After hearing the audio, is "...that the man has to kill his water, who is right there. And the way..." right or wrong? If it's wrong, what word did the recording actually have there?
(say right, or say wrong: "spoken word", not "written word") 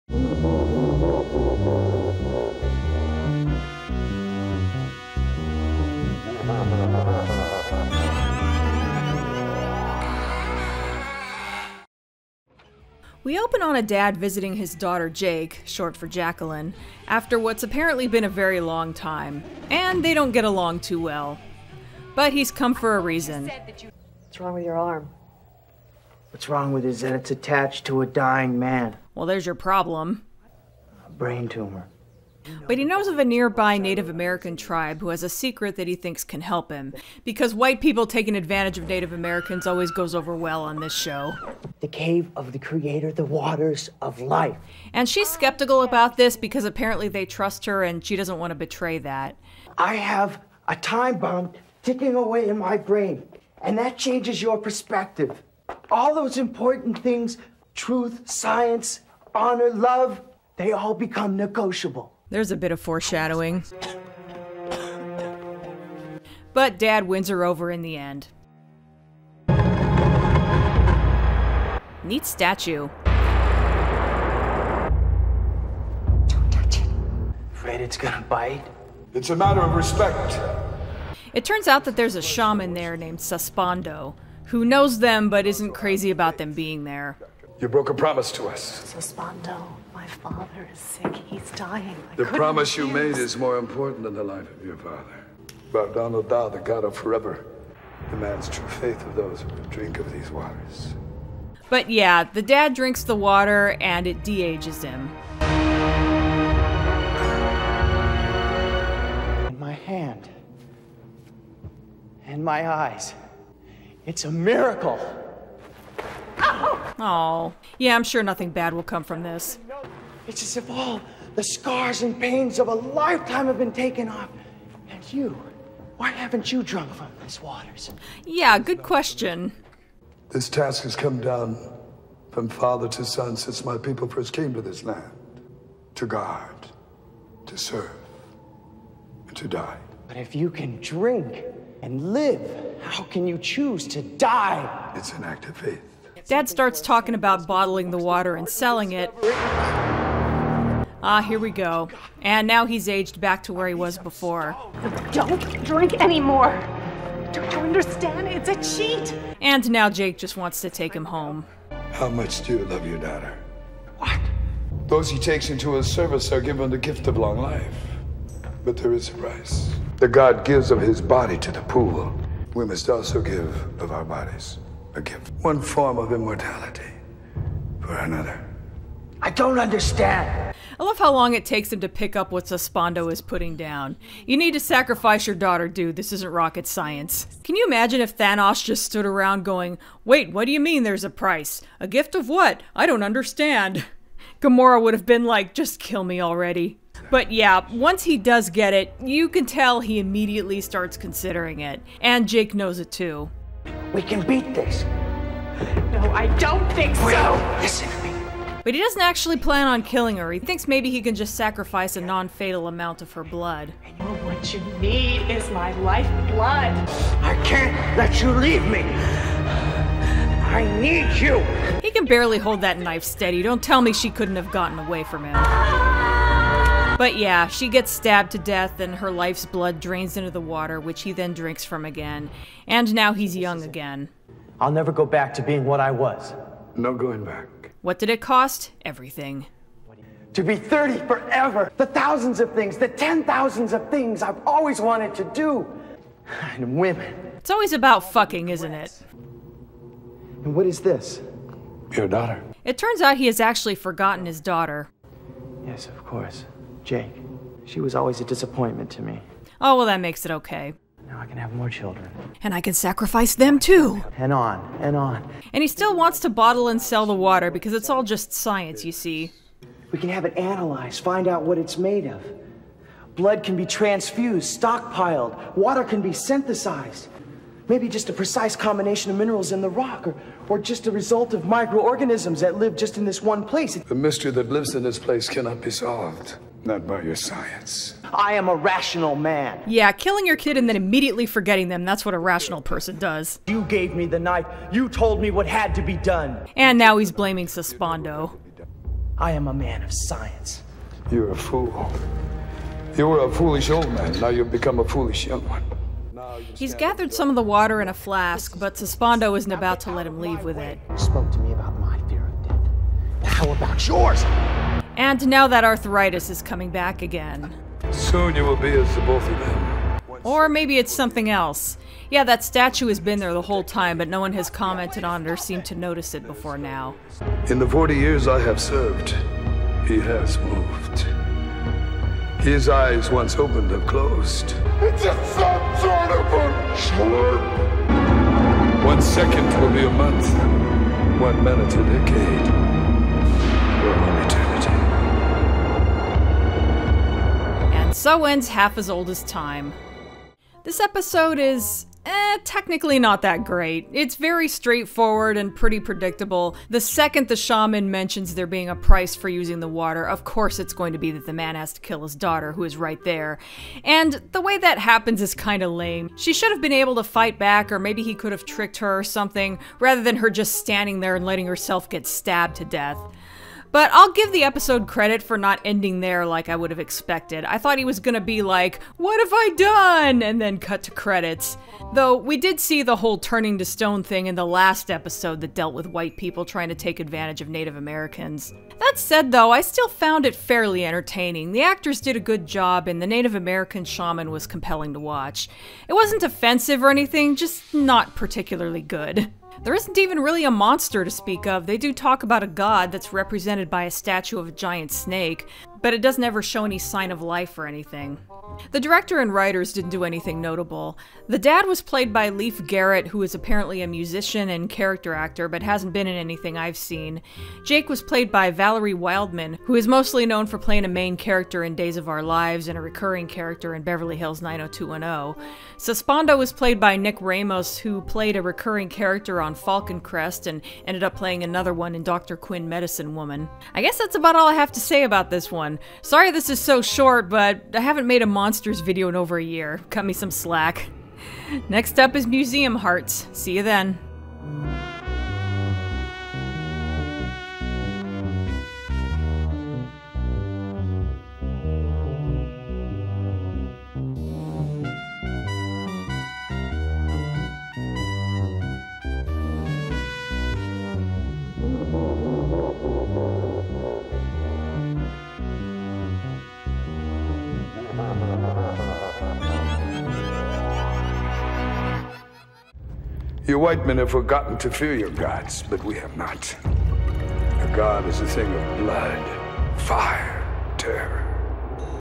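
wrong: "daughter", not "water".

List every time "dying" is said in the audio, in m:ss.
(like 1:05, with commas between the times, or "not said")
0:28, 1:31.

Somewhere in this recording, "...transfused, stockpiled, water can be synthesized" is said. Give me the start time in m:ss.
4:33.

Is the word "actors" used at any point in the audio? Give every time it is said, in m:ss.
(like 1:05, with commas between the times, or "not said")
6:31, 6:55.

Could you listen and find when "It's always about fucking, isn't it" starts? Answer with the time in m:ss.
4:07.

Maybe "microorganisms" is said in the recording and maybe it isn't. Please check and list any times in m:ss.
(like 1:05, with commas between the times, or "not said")
4:41.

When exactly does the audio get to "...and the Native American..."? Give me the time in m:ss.
6:32.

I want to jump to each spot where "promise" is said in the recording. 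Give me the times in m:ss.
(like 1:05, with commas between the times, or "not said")
1:27, 1:32.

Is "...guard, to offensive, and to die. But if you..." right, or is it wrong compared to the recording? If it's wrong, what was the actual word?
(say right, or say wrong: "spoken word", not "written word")
wrong: "serve", not "offensive".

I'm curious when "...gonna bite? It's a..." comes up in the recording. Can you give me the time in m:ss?
1:17.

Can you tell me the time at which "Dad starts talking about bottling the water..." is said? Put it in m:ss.
2:26.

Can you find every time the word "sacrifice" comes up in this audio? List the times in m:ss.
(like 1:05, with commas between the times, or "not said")
3:04, 3:31, 4:22.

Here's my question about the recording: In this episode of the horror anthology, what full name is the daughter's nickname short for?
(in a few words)
Jacqueline.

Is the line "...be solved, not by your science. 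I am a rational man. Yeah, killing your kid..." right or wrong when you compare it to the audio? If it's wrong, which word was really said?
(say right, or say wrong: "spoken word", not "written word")
right.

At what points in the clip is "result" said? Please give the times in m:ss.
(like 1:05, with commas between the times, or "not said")
4:40.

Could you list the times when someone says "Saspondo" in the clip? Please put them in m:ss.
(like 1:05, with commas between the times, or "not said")
3:02, 7:05.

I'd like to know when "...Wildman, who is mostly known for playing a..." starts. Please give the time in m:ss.
6:58.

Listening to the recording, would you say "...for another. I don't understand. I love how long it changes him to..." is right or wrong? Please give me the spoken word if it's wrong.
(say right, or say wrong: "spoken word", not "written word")
wrong: "takes", not "changes".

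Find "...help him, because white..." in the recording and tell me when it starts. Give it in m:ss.
0:36.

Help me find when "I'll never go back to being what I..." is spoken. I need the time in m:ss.
3:54.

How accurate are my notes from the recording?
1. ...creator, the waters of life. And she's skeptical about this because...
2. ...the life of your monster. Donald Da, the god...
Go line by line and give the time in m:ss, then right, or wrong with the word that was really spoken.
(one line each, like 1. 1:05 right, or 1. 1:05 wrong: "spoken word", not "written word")
1. 0:42 right
2. 1:34 wrong: "father", not "monster".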